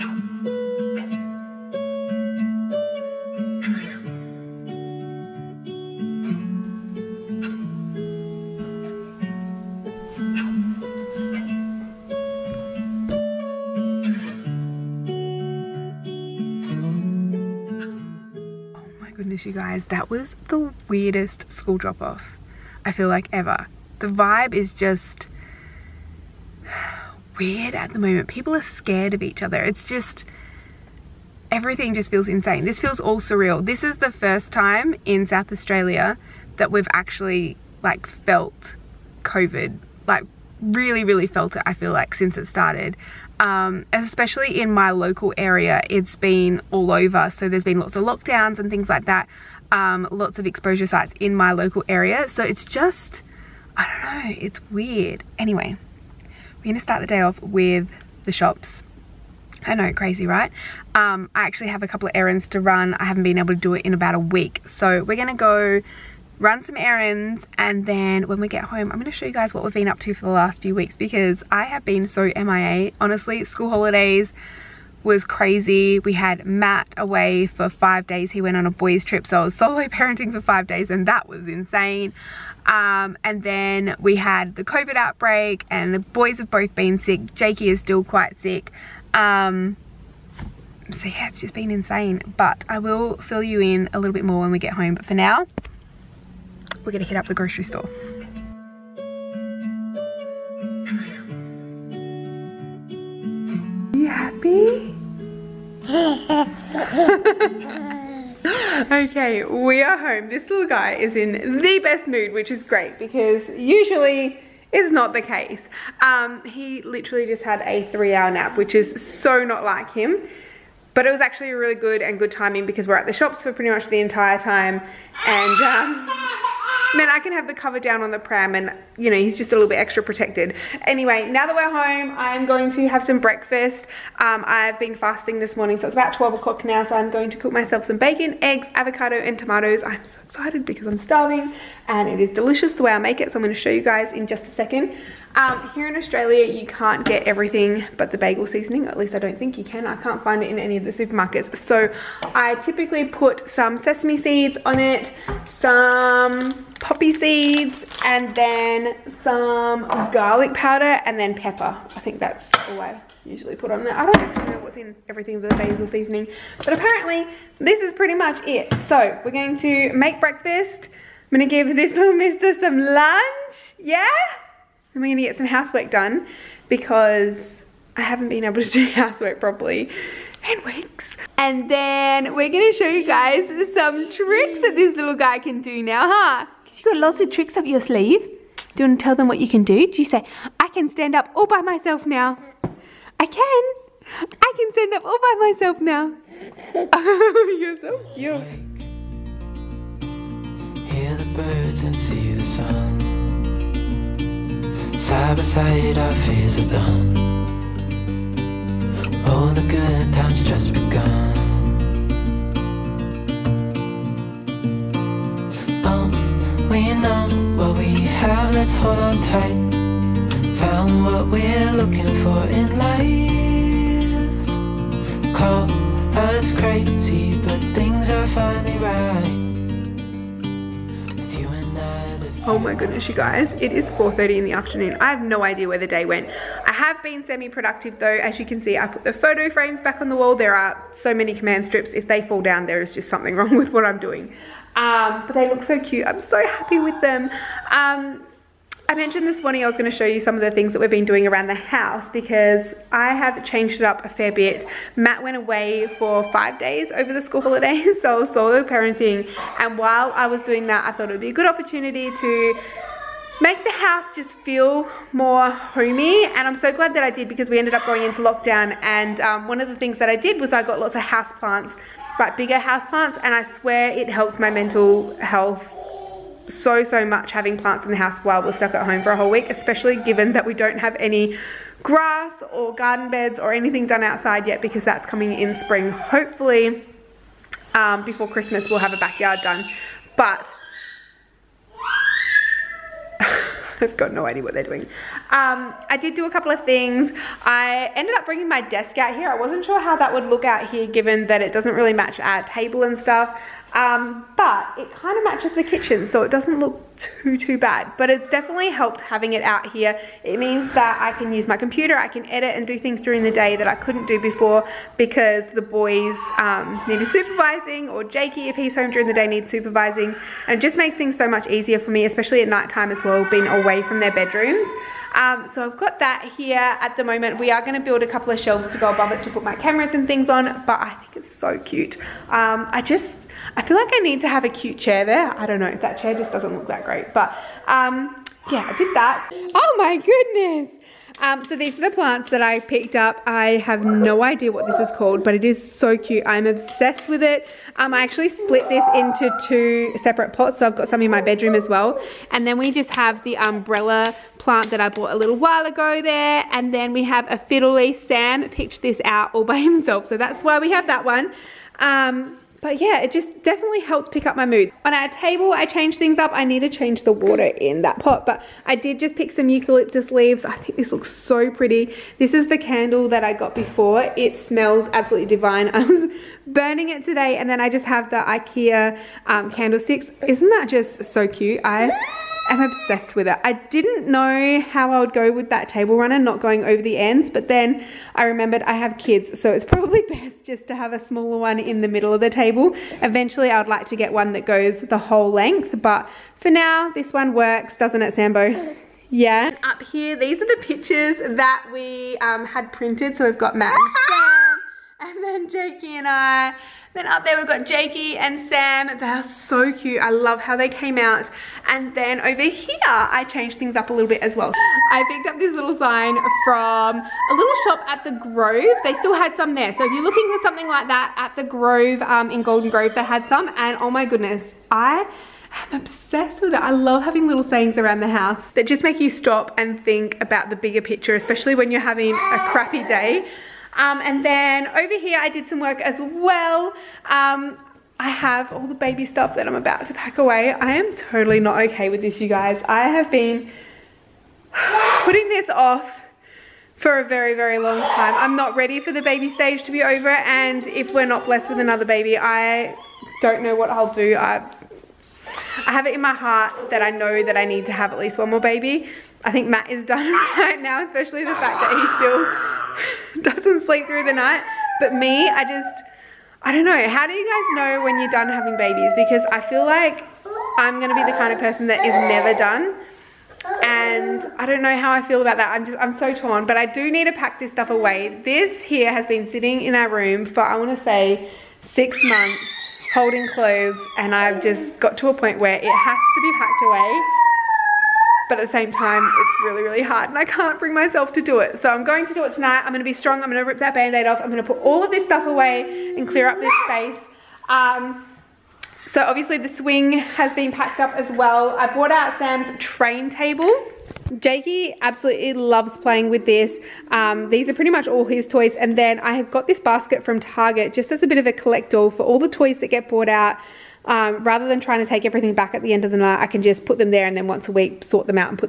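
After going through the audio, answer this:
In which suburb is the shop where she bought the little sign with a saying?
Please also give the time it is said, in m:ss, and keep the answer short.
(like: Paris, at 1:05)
Golden Grove, at 7:02.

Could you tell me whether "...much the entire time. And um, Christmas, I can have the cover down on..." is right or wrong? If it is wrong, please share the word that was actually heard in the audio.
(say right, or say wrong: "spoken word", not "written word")
wrong: "Man", not "Christmas".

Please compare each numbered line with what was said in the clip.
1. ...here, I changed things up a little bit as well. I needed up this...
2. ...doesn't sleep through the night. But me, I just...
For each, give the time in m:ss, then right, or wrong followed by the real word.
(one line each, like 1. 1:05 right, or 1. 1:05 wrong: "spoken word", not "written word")
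1. 6:52 wrong: "picked", not "needed"
2. 7:43 right.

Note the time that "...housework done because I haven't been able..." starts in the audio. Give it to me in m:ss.
2:55.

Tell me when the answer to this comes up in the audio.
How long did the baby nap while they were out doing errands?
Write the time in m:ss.
1:57.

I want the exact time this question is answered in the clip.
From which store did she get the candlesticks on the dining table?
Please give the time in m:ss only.
6:18.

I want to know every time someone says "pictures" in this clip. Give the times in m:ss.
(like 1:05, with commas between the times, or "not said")
6:40, 7:10.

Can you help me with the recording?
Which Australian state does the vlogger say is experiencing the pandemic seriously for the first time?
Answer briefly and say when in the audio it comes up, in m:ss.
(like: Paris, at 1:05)
South Australia, at 0:35.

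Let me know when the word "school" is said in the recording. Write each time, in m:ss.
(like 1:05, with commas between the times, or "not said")
0:21, 1:13, 4:17.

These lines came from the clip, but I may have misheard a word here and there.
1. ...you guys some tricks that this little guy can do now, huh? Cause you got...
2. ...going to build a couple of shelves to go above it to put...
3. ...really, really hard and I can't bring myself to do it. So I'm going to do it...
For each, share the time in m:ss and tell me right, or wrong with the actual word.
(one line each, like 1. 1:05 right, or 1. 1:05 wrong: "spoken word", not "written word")
1. 3:02 right
2. 5:27 right
3. 8:09 right.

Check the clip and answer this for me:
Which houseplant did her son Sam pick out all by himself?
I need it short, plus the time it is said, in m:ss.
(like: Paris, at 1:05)
Fiddle leaf, at 5:57.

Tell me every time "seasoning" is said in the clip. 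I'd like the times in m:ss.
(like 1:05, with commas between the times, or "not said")
2:28, 2:45.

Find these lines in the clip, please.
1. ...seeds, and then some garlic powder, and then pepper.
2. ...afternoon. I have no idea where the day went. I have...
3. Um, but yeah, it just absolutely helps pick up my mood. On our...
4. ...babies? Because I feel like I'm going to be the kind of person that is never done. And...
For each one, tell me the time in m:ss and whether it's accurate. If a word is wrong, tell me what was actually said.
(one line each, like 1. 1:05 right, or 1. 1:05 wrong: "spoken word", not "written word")
1. 2:37 right
2. 3:54 right
3. 6:01 wrong: "definitely", not "absolutely"
4. 7:48 right.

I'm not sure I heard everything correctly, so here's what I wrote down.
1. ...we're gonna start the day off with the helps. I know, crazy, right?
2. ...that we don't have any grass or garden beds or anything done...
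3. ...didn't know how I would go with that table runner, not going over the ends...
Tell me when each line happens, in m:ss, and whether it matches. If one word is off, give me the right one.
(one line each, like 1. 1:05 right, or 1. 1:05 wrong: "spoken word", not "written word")
1. 0:56 wrong: "shops", not "helps"
2. 4:40 right
3. 6:23 right.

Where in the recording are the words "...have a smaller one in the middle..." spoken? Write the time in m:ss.
6:30.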